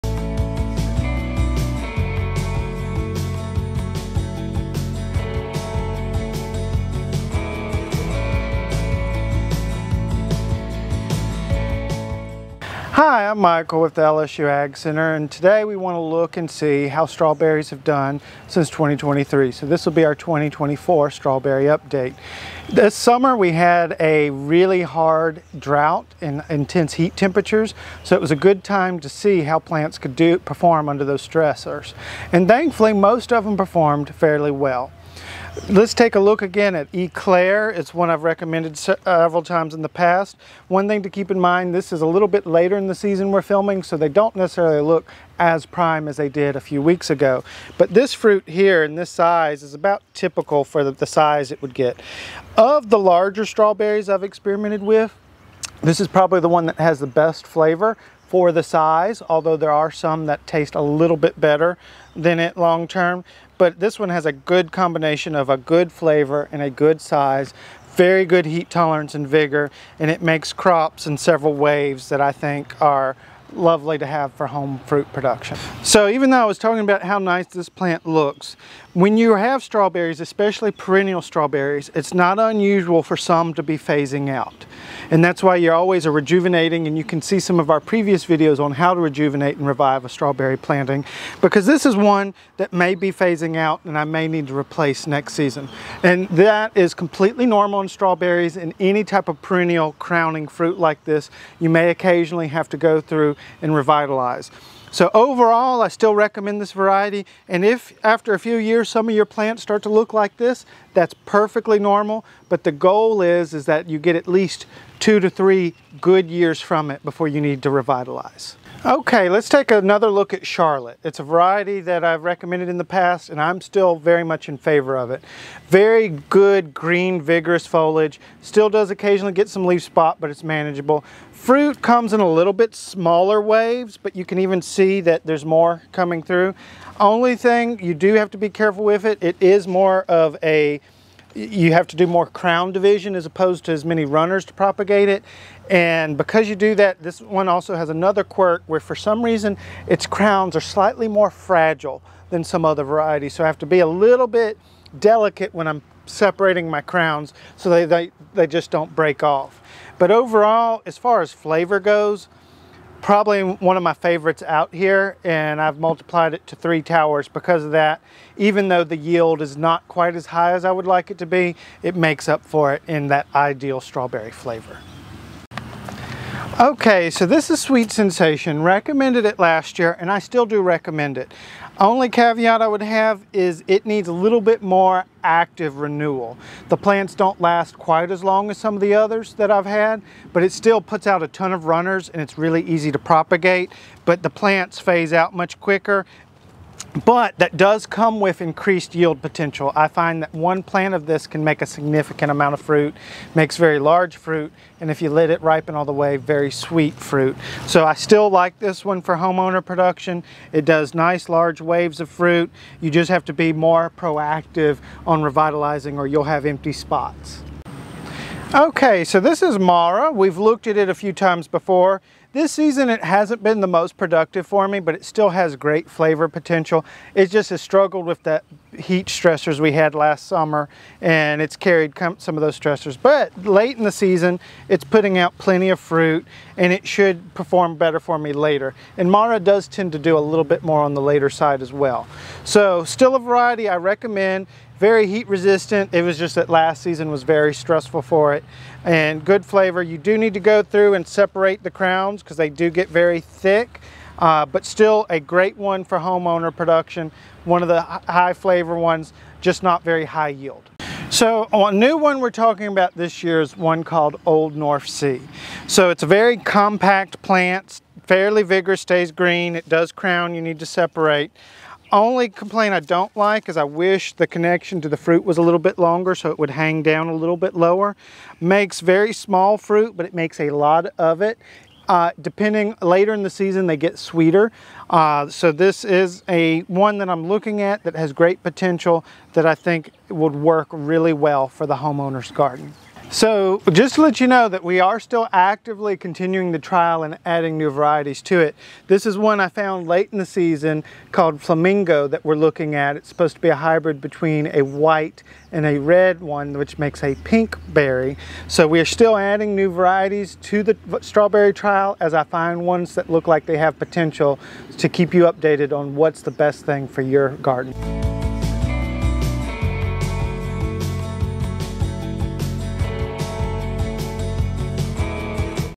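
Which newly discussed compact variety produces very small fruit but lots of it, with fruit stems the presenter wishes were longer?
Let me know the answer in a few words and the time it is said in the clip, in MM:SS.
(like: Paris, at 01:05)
Old North Sea, at 04:24.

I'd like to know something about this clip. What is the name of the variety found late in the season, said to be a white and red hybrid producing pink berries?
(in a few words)
Flamingo.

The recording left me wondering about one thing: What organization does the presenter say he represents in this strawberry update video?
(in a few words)
LSU Ag Center.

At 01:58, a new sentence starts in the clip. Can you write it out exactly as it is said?
Okay, let's take another look at Charlotte.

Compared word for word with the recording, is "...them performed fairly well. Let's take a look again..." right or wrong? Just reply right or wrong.
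right.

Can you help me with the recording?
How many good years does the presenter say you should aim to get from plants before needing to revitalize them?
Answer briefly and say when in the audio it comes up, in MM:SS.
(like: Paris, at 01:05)
2 to 3, at 01:54.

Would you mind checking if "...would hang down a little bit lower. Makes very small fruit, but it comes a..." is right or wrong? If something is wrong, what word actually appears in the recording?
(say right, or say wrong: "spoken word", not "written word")
wrong: "makes", not "comes".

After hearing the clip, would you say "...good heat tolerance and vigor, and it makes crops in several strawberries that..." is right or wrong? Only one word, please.
wrong.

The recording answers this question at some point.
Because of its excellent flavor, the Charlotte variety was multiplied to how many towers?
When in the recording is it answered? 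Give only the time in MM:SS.
02:46.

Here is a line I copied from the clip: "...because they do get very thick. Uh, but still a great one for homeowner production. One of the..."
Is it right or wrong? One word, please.
right.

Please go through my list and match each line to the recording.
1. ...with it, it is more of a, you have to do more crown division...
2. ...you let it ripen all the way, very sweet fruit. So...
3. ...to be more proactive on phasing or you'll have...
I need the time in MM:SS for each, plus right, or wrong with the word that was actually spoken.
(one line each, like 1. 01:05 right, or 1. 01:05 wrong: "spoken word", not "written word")
1. 02:18 right
2. 03:25 right
3. 03:33 wrong: "revitalizing", not "phasing".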